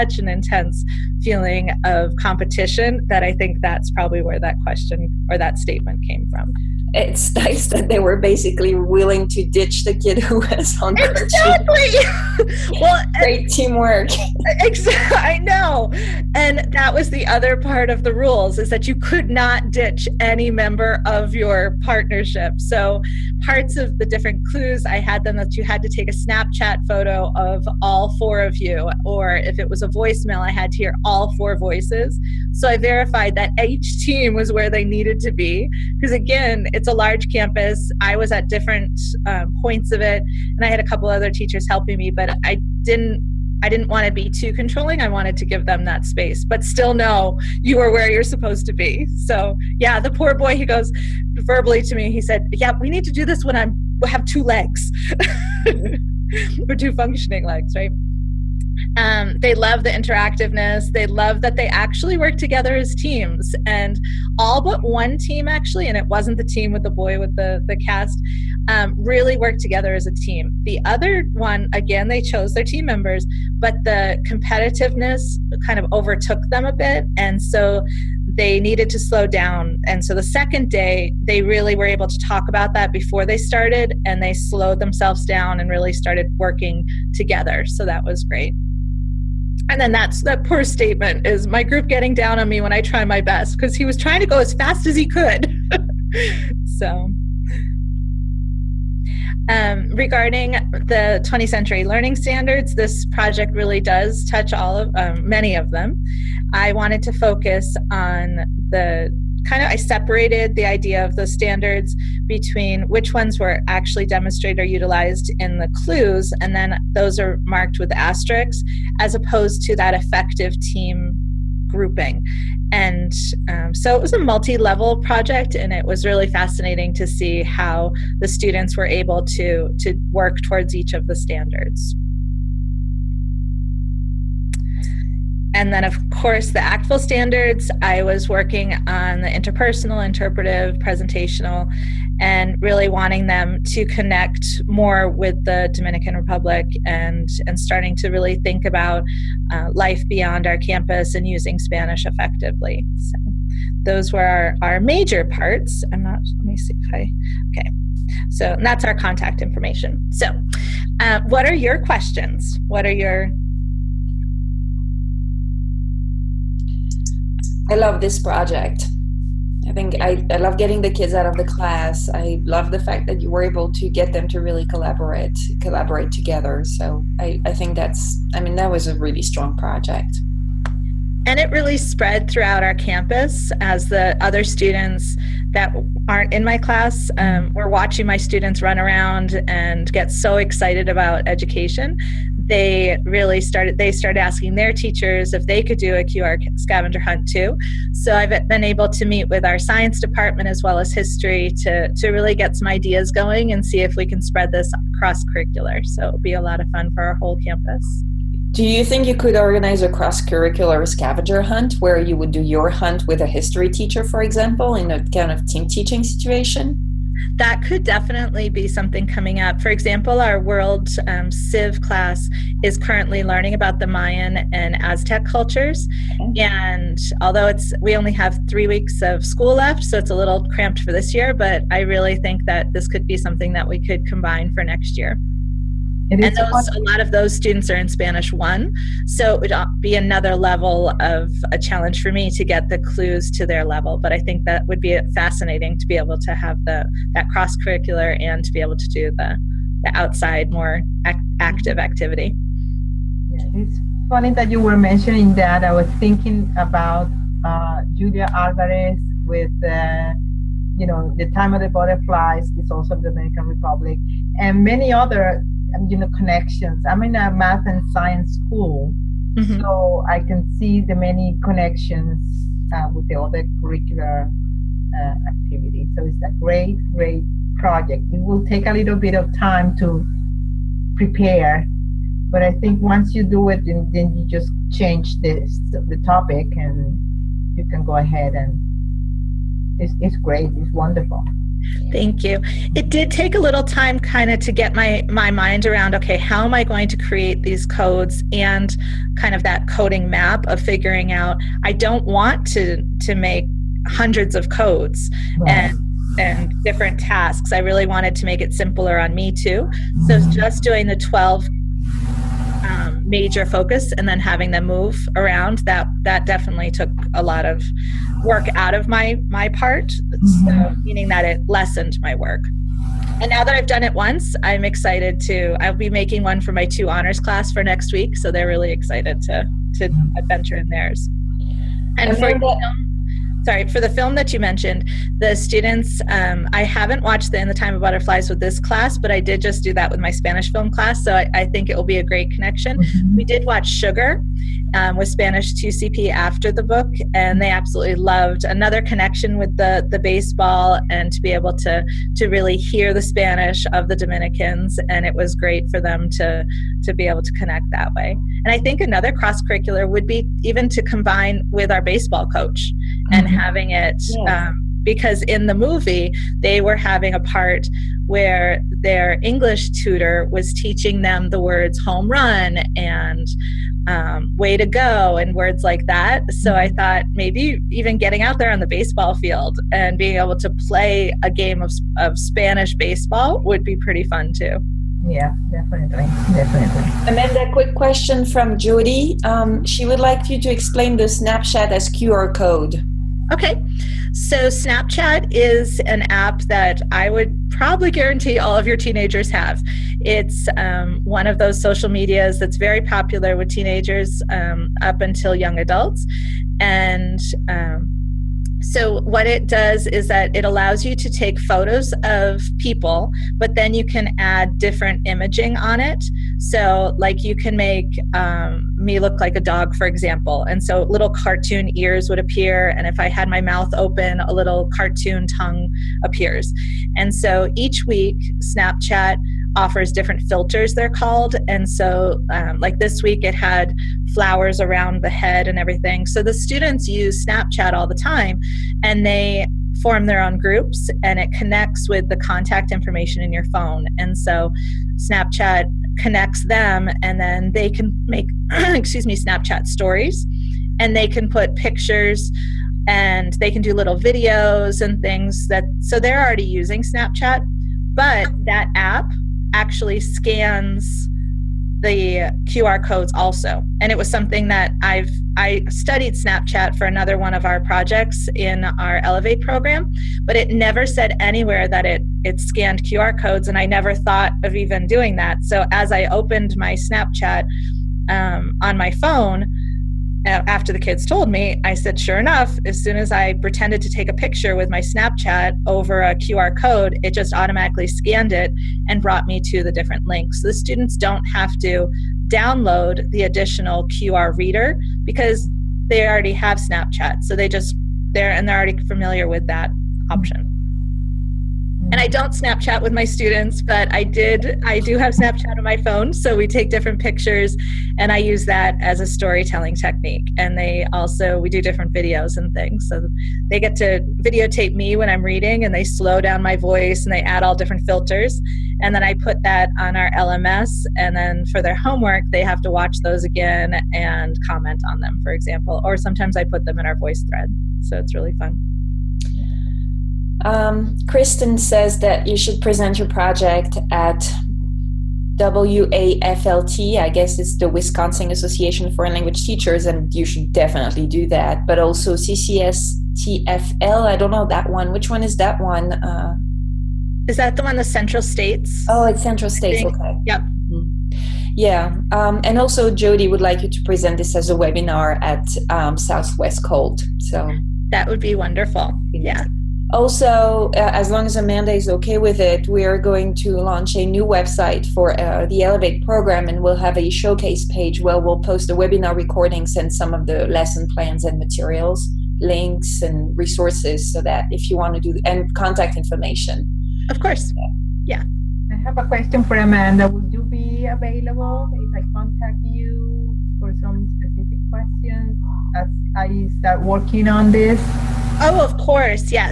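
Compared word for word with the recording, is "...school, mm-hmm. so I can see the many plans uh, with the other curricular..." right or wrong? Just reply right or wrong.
wrong.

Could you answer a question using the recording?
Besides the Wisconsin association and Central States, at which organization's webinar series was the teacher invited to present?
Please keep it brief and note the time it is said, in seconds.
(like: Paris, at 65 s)
Southwest COLT, at 555 s.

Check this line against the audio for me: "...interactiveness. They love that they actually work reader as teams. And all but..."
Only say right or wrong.
wrong.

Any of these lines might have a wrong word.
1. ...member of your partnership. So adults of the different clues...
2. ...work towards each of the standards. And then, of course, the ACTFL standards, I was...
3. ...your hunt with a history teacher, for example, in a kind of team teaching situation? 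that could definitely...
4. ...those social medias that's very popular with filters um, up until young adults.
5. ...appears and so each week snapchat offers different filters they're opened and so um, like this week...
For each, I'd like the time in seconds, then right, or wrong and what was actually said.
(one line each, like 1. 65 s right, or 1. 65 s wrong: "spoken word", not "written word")
1. 20 s wrong: "parts", not "adults"
2. 130 s right
3. 212 s right
4. 401 s wrong: "teenagers", not "filters"
5. 426 s wrong: "called", not "opened".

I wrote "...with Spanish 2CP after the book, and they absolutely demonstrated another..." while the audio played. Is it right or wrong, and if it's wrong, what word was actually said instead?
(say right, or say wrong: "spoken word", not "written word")
wrong: "loved", not "demonstrated".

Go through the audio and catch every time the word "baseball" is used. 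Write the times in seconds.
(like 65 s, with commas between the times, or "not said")
349 s, 361 s, 378 s, 382 s.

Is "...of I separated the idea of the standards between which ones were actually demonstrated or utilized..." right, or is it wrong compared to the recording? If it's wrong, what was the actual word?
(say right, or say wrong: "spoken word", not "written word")
right.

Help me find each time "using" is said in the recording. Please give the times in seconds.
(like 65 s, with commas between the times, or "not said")
151 s, 456 s.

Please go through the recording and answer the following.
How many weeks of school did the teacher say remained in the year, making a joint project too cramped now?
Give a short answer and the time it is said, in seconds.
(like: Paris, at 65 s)
3, at 228 s.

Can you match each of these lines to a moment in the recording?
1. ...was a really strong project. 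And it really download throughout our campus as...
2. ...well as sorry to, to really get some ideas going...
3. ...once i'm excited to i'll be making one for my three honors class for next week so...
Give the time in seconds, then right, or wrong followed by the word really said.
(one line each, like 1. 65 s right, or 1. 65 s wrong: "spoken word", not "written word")
1. 178 s wrong: "spread", not "download"
2. 200 s wrong: "history", not "sorry"
3. 323 s wrong: "two", not "three".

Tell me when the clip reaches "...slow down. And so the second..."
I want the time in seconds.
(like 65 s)
78 s.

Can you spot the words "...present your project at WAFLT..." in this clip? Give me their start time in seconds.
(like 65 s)
532 s.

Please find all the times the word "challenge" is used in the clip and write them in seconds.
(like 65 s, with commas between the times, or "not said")
241 s.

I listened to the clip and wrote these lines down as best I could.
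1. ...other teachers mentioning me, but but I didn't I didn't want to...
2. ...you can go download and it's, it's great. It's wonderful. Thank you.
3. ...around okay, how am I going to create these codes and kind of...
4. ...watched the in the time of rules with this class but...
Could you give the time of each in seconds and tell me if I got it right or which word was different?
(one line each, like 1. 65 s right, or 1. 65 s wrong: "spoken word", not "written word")
1. 41 s wrong: "helping", not "mentioning"
2. 287 s wrong: "ahead", not "download"
3. 295 s right
4. 337 s wrong: "butterflies", not "rules".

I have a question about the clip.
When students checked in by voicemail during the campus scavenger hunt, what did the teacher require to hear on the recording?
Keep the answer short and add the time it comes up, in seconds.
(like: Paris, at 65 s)
all four voices, at 31 s.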